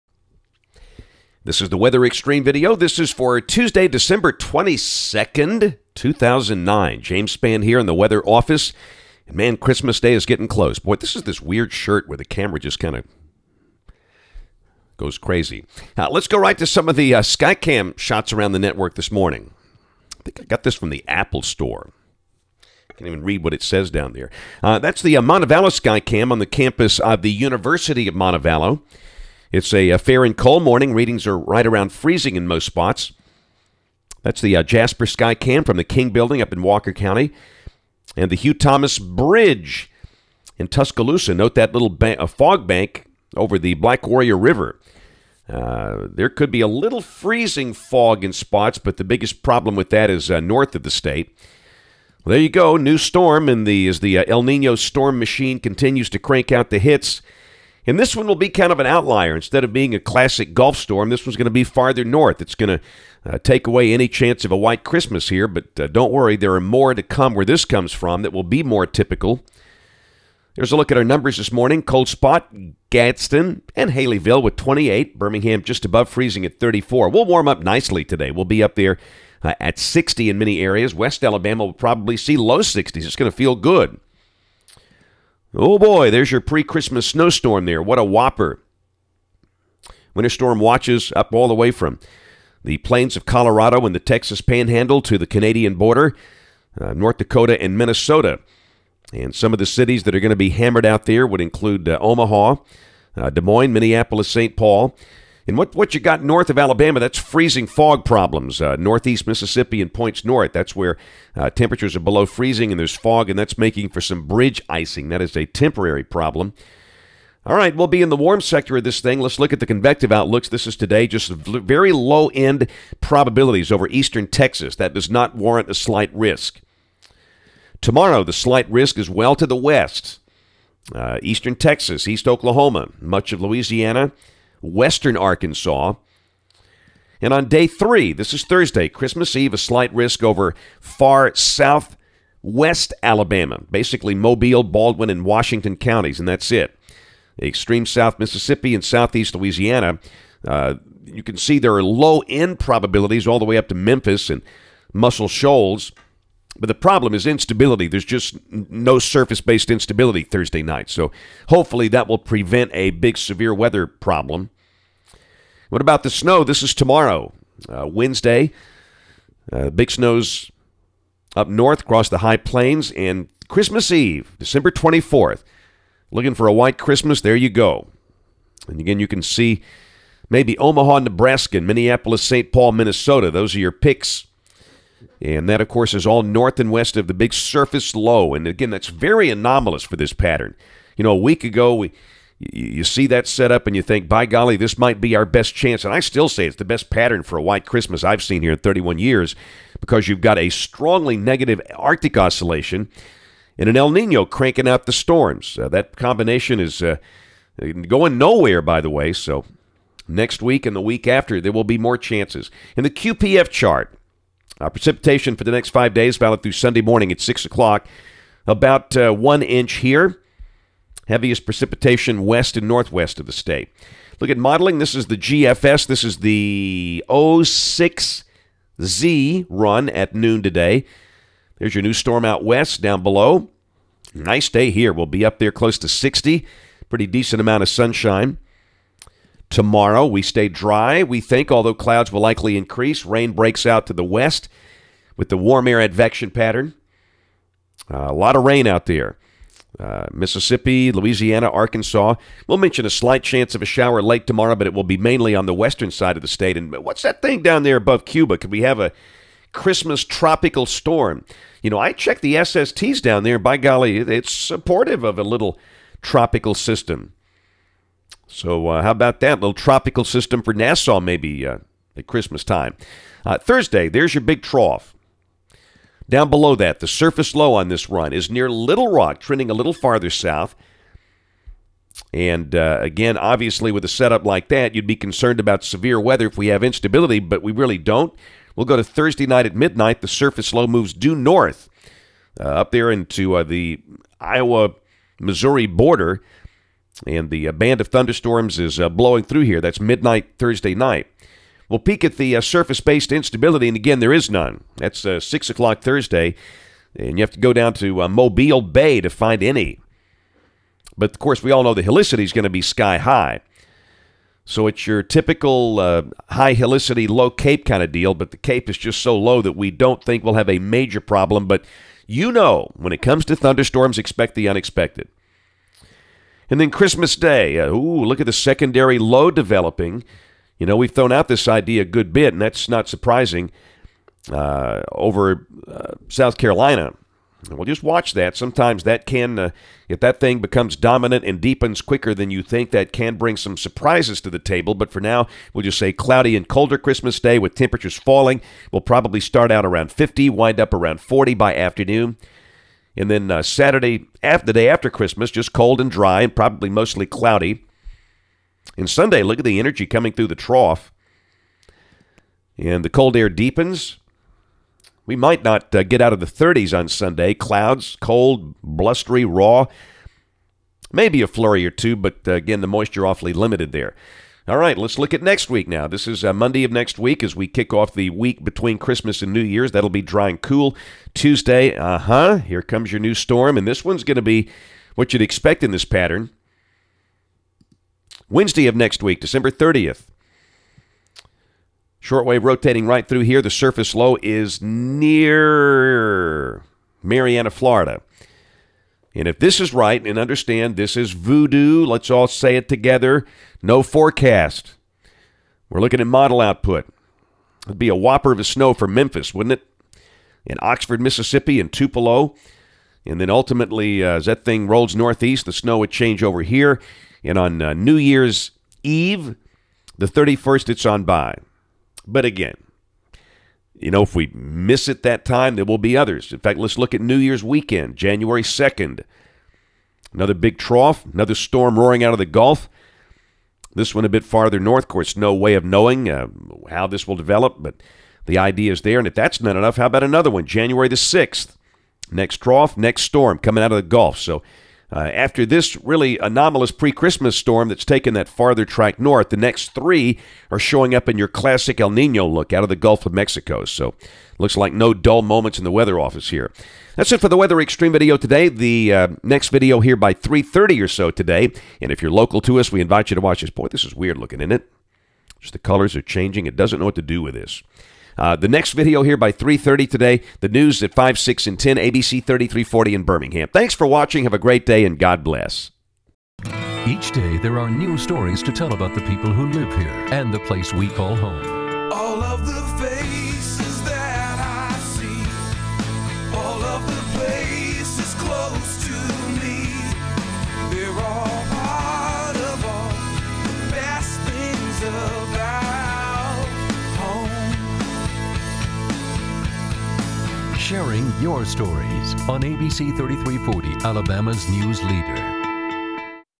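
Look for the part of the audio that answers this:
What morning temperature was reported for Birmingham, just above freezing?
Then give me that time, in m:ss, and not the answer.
1:16.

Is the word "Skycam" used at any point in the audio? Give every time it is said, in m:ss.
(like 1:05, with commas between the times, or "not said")
0:17, 0:25.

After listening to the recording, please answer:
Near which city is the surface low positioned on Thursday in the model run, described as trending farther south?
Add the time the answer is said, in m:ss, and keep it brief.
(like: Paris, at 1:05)
Little Rock, at 4:38.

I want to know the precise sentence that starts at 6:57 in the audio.
And on uh, New Year's Eve, the 31st, it's on by.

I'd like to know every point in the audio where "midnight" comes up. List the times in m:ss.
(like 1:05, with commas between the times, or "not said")
4:49, 4:59.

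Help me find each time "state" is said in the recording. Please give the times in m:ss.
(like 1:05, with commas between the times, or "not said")
0:50, 3:43, 4:16.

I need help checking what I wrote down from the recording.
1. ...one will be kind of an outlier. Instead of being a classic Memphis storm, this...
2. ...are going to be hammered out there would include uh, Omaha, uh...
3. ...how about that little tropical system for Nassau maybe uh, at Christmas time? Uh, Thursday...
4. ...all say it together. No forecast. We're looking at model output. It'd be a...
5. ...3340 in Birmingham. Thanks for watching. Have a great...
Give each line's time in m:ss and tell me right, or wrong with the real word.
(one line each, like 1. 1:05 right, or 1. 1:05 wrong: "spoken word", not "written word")
1. 0:58 wrong: "Gulf", not "Memphis"
2. 1:40 right
3. 4:28 right
4. 6:42 right
5. 7:52 right.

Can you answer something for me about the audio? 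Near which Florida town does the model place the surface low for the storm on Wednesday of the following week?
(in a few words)
Marianna.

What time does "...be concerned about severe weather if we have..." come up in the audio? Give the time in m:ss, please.
4:44.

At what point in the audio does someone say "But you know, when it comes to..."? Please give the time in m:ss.
5:21.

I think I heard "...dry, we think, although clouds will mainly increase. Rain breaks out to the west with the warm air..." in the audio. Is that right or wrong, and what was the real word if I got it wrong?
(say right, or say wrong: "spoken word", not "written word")
wrong: "likely", not "mainly".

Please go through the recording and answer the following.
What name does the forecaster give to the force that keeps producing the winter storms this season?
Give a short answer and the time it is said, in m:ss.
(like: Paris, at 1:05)
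El Nino storm machine, at 0:54.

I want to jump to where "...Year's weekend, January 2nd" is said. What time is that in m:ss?
7:07.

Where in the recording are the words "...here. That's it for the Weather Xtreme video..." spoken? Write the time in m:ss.
7:36.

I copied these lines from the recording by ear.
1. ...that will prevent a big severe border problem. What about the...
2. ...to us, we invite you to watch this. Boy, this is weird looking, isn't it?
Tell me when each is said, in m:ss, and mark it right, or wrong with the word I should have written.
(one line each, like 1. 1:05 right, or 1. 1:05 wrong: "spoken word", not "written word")
1. 2:41 wrong: "weather", not "border"
2. 7:42 right.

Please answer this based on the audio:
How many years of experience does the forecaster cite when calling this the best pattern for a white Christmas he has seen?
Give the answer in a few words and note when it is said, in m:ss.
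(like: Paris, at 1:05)
31, at 3:18.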